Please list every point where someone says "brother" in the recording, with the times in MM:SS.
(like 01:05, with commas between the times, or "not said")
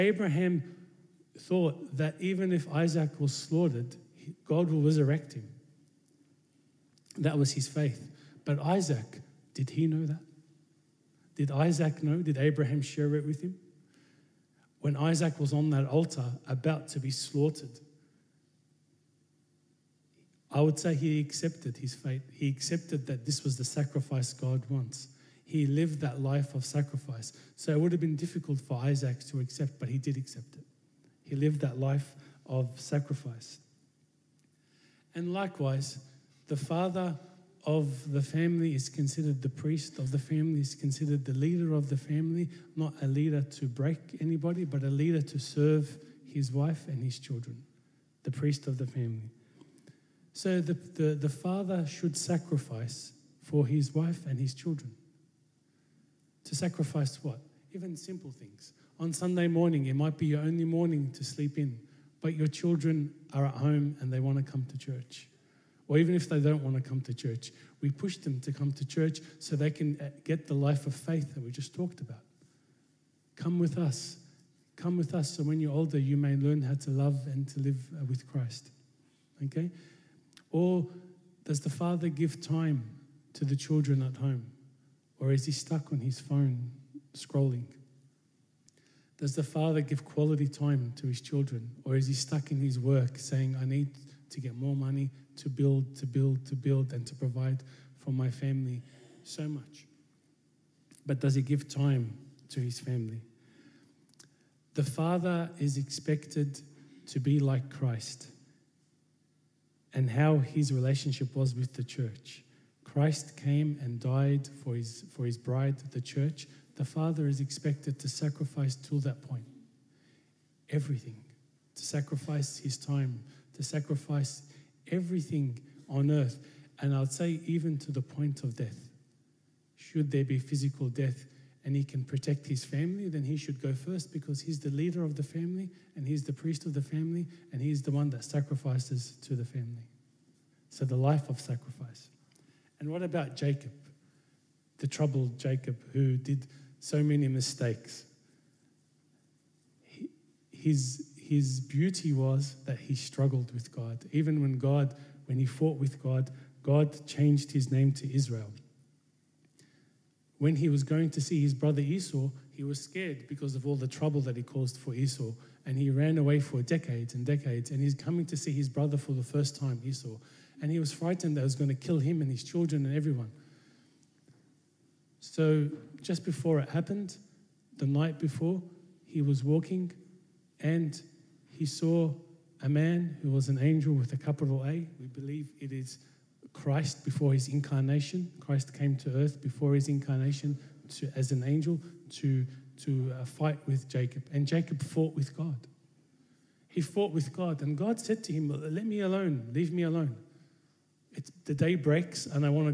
02:41, 02:48.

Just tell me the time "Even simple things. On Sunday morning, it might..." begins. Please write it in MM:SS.
00:57.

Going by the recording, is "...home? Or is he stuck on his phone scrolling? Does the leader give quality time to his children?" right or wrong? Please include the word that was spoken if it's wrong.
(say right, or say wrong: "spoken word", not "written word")
wrong: "father", not "leader".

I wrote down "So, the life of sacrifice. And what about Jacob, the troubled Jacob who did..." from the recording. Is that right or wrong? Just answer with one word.
right.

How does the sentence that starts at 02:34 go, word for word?
Even when God, when he fought with God, God changed his name to Israel.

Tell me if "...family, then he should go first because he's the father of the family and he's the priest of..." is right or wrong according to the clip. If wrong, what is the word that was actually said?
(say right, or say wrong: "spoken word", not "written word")
wrong: "leader", not "father".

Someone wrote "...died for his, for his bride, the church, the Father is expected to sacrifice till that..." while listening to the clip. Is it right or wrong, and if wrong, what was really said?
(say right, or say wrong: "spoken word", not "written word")
right.